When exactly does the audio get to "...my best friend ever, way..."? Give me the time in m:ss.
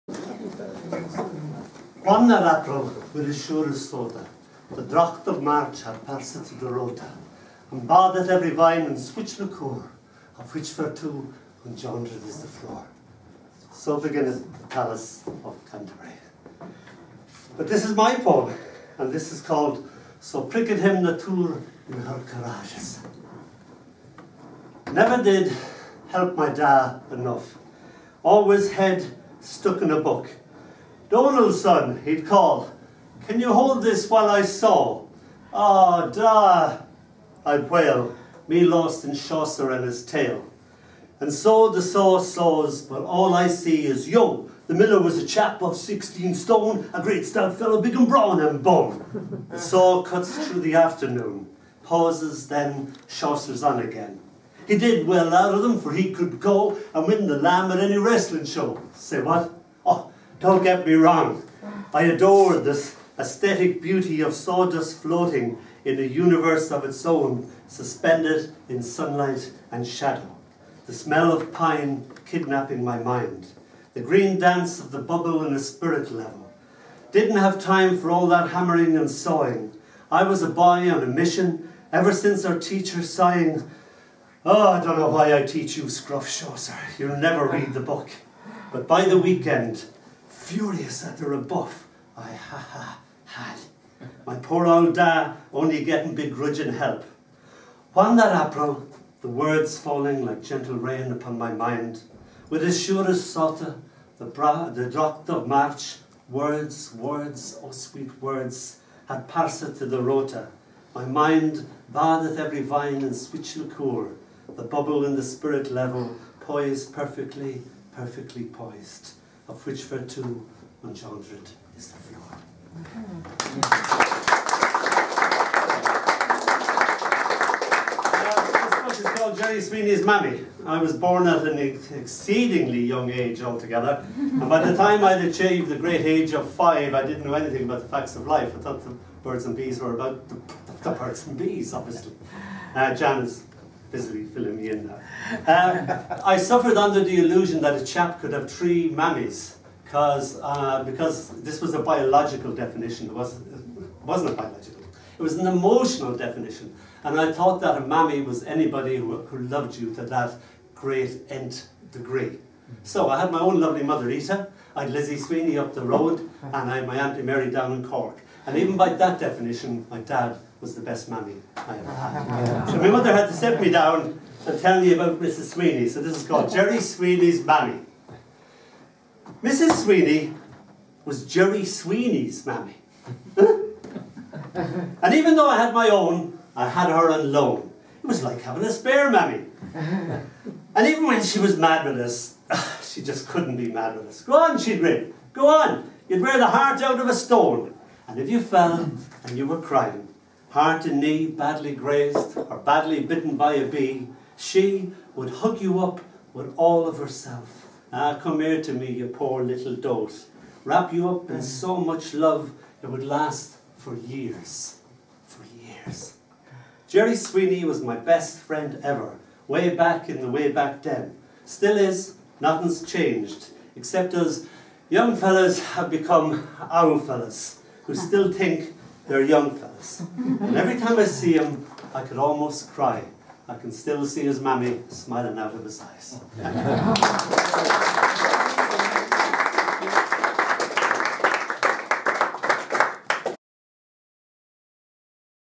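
3:37.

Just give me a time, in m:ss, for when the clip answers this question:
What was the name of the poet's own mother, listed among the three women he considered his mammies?
2:44.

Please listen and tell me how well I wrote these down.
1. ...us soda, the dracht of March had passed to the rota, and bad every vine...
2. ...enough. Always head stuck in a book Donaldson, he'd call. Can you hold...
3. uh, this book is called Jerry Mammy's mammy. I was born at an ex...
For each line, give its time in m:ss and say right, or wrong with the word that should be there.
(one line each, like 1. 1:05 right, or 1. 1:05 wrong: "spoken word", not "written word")
1. 0:03 right
2. 0:27 right
3. 2:08 wrong: "Sweeney", not "Mammy".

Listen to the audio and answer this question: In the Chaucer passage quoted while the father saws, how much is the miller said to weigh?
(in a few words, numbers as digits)
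16 stone.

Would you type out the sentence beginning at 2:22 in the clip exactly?
Uh, busily filling me in now.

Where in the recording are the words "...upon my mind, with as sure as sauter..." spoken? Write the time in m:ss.
1:41.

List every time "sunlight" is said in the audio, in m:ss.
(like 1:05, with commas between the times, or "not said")
1:08.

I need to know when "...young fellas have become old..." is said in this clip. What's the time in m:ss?
3:44.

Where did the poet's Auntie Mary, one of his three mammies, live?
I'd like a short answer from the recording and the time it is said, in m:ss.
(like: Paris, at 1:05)
Cork, at 2:47.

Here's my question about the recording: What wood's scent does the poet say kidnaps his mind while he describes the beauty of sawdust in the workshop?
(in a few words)
Pine.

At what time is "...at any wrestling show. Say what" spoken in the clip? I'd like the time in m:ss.
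0:57.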